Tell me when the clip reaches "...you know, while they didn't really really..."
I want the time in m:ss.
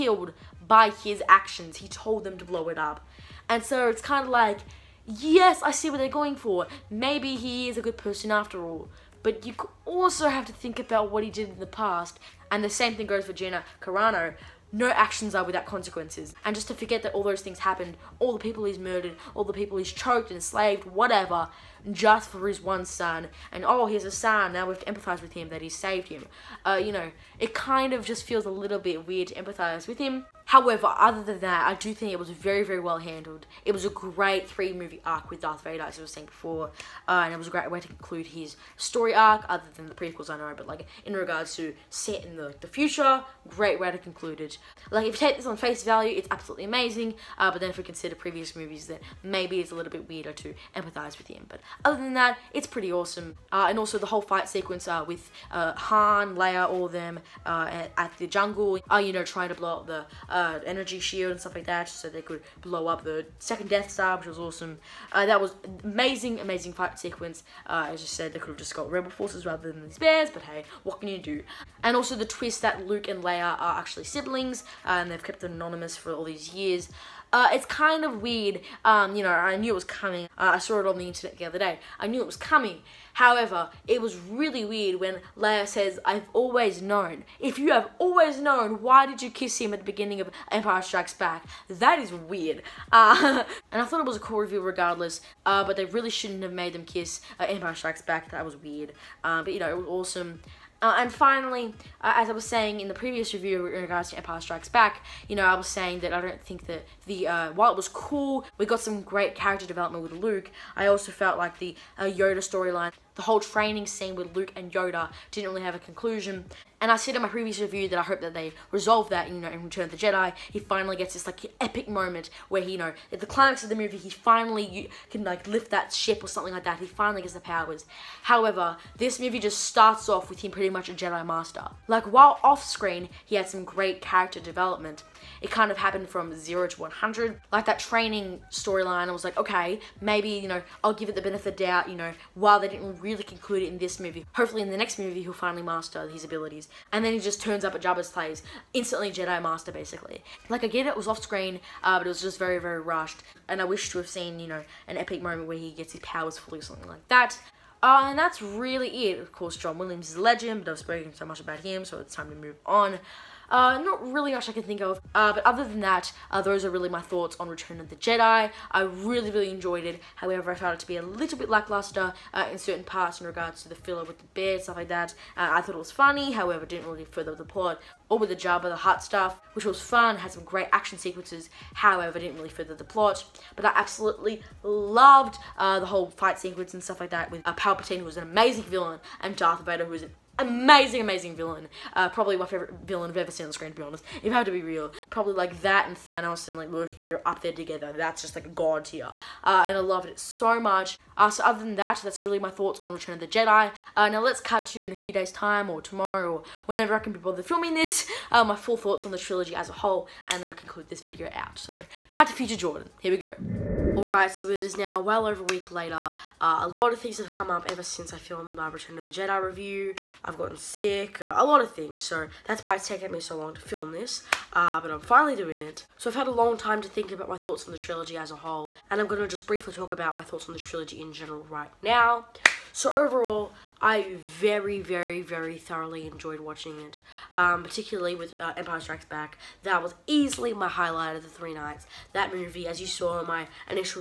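2:21.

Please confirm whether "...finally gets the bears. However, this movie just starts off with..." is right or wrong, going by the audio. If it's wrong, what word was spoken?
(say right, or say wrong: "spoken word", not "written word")
wrong: "powers", not "bears".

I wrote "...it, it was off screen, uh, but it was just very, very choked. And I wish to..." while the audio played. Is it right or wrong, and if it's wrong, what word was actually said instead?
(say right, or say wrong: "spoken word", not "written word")
wrong: "rushed", not "choked".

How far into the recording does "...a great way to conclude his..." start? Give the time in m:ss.
0:37.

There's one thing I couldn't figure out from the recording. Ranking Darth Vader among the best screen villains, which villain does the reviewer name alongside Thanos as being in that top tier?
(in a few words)
Loki.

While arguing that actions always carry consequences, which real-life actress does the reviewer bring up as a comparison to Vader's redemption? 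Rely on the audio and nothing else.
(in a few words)
Gina Carano.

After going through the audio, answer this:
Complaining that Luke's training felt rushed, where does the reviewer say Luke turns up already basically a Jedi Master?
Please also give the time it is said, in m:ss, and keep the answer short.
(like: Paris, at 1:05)
Jabba's place, at 2:27.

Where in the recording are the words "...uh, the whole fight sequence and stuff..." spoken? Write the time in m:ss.
3:05.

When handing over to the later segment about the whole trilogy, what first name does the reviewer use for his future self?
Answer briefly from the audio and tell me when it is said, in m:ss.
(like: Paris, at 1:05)
Jordan, at 3:32.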